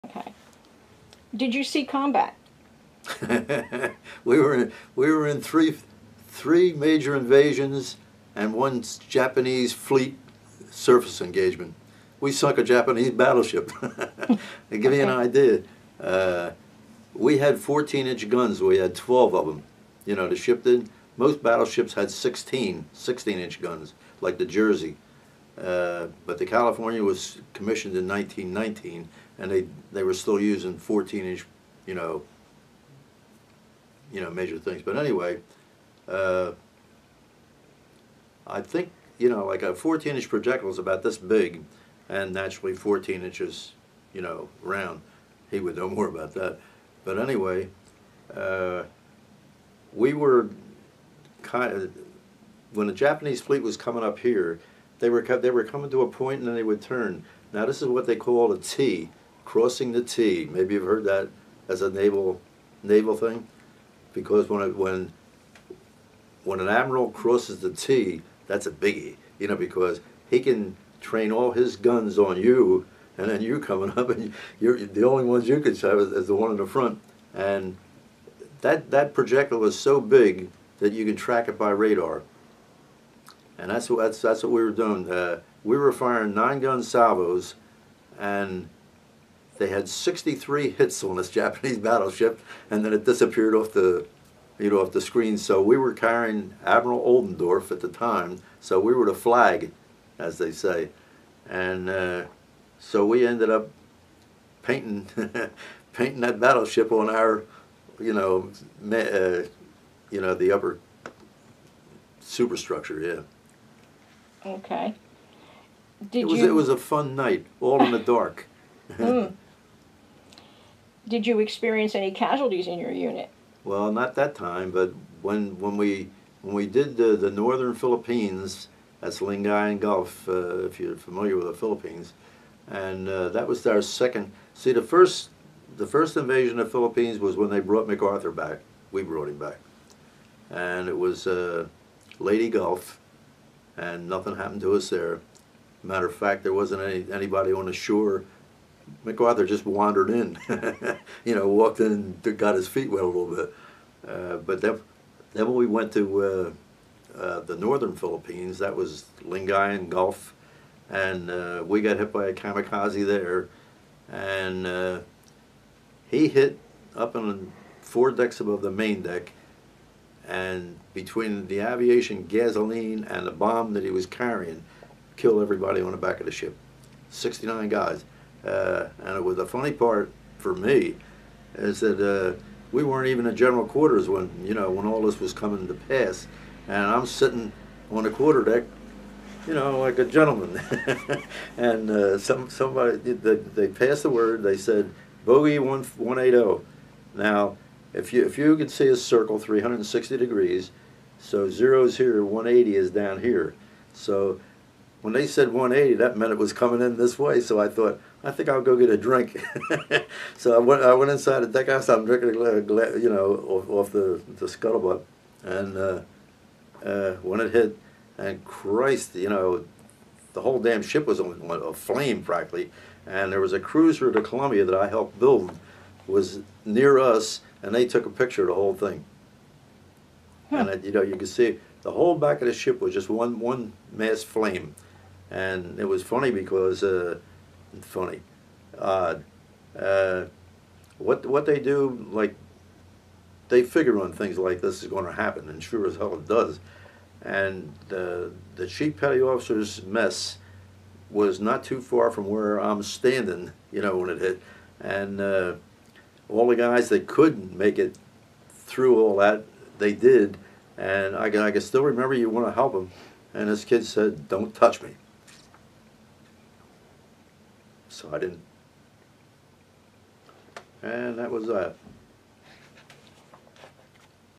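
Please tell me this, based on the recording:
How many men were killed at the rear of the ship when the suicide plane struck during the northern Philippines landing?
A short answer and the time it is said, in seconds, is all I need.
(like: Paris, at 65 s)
69, at 177 s.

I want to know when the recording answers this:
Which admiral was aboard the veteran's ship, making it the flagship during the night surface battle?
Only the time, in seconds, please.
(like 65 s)
96 s.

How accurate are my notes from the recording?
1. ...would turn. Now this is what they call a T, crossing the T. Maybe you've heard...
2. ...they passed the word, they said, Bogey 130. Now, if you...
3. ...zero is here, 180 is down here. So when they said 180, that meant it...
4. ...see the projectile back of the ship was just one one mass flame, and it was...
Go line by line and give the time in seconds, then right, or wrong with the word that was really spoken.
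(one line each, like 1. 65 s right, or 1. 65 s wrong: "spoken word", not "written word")
1. 56 s right
2. 193 s wrong: "180", not "130"
3. 201 s right
4. 231 s wrong: "whole", not "projectile".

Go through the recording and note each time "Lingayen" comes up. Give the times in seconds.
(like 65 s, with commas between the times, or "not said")
129 s, 159 s.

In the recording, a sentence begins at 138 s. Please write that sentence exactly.
We brought him back, and it was uh, Leyte Gulf, and nothing happened to us there.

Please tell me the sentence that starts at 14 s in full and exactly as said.
you an idea, uh, we had 14-inch guns.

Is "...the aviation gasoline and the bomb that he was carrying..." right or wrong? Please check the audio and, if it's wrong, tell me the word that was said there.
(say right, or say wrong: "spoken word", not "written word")
right.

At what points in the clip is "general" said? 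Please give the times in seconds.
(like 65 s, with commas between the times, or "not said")
183 s.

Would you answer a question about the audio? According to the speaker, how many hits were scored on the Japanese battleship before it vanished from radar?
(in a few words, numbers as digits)
63.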